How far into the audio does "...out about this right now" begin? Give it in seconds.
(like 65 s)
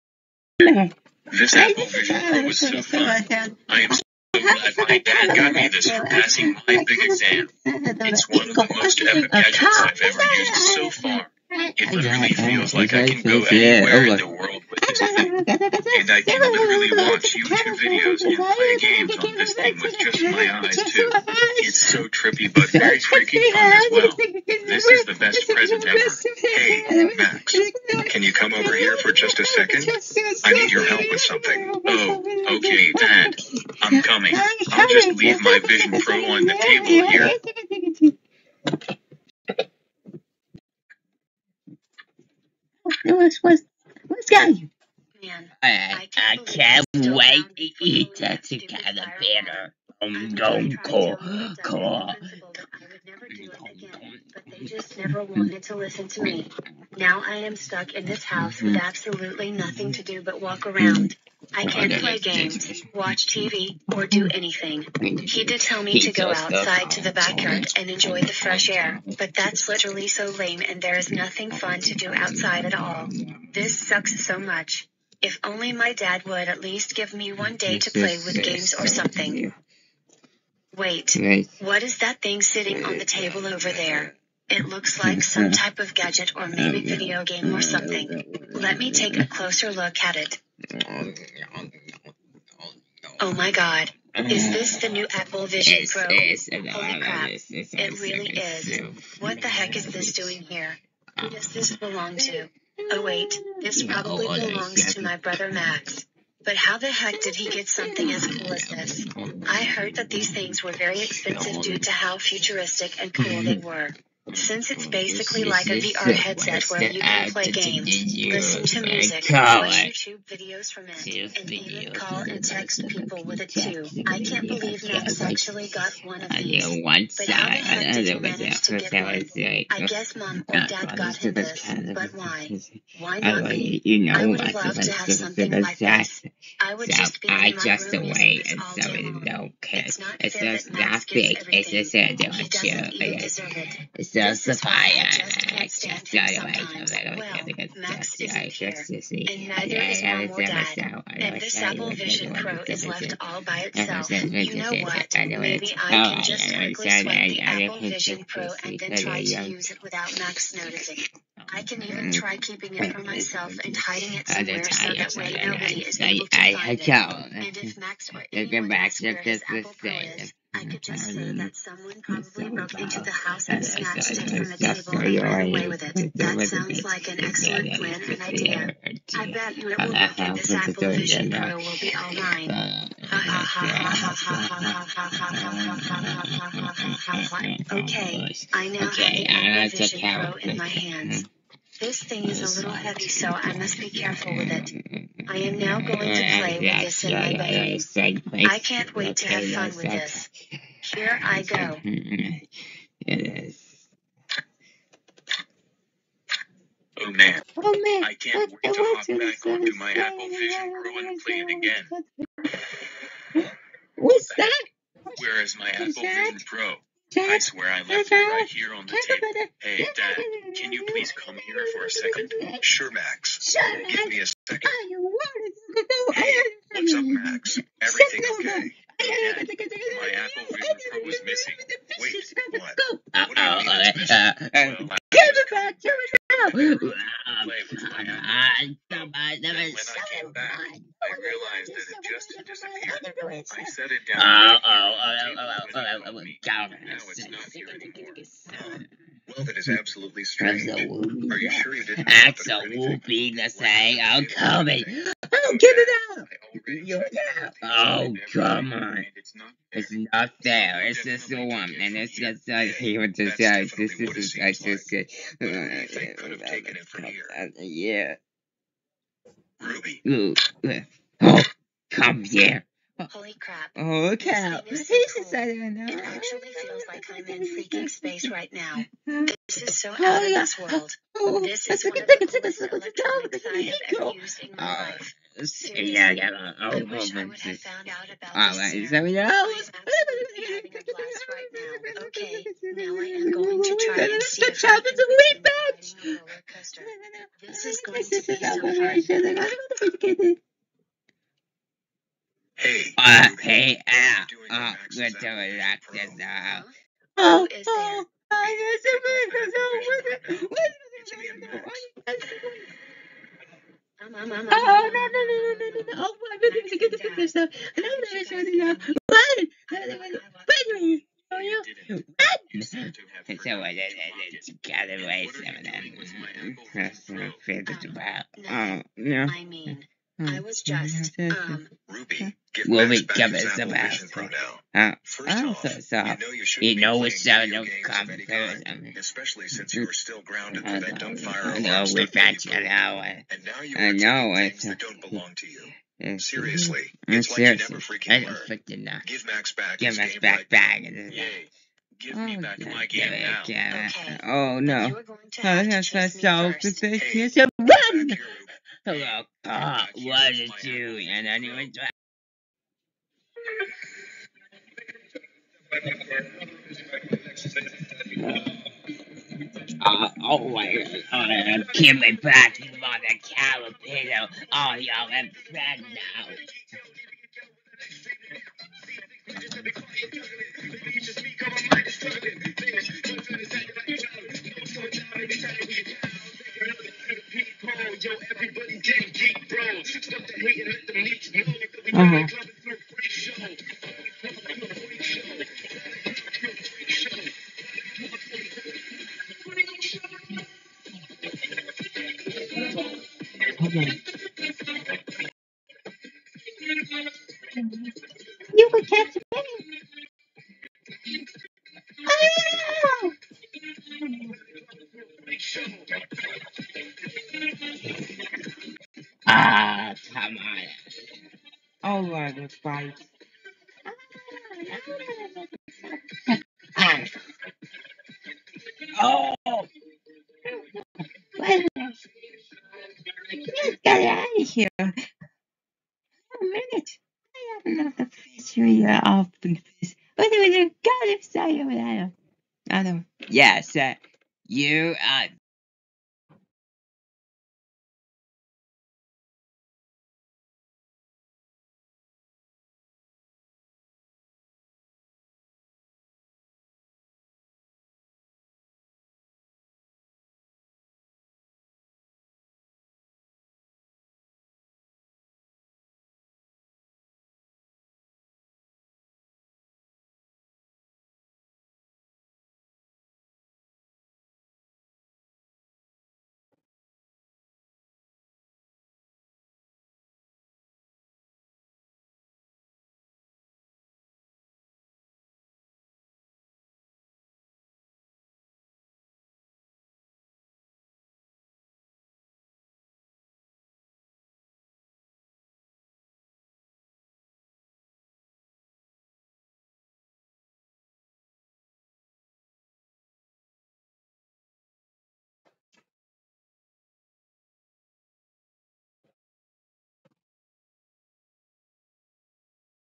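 287 s.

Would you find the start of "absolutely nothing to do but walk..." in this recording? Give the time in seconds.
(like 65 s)
58 s.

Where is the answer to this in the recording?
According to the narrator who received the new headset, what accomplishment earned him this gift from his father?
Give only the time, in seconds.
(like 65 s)
6 s.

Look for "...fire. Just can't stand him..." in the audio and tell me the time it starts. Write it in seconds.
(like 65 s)
144 s.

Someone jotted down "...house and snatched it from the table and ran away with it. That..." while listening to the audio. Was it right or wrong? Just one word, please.
right.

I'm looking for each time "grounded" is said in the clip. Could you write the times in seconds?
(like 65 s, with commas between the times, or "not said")
340 s.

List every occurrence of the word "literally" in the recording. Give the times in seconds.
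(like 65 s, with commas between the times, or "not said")
11 s, 16 s, 69 s.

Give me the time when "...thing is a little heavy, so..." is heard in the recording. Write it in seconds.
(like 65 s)
192 s.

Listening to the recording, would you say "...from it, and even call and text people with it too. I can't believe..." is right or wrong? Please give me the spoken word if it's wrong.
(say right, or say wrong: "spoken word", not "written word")
right.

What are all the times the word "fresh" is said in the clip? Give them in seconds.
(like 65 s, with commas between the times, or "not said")
68 s.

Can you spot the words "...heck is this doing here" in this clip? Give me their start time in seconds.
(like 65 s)
99 s.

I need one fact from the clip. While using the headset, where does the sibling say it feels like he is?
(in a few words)
space.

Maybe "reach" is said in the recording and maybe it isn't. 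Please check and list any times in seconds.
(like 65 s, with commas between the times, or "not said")
not said.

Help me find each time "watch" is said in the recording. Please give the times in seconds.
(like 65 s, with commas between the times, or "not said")
17 s, 62 s, 119 s.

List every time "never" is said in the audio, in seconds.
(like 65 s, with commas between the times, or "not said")
54 s, 347 s.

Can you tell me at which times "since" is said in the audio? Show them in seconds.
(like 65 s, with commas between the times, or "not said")
114 s, 339 s.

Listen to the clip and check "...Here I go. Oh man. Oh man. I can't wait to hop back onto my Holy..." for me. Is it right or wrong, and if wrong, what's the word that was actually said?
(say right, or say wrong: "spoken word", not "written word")
wrong: "Apple", not "Holy".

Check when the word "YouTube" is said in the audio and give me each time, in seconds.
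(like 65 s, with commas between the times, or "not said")
17 s, 119 s.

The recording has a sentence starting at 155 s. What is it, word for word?
Maybe I oh, can just quickly swipe the Apple Vision Pro and then try to um, use it without Max noticing.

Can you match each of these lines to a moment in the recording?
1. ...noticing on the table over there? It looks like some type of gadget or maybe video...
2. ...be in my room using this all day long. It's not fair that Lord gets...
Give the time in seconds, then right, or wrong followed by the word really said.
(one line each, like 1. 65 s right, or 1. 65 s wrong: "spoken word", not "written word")
1. 82 s wrong: "sitting", not "noticing"
2. 137 s wrong: "Max", not "Lord".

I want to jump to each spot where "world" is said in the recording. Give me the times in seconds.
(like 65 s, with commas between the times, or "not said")
14 s, 280 s.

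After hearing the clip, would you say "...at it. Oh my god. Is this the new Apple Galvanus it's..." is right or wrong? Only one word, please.
wrong.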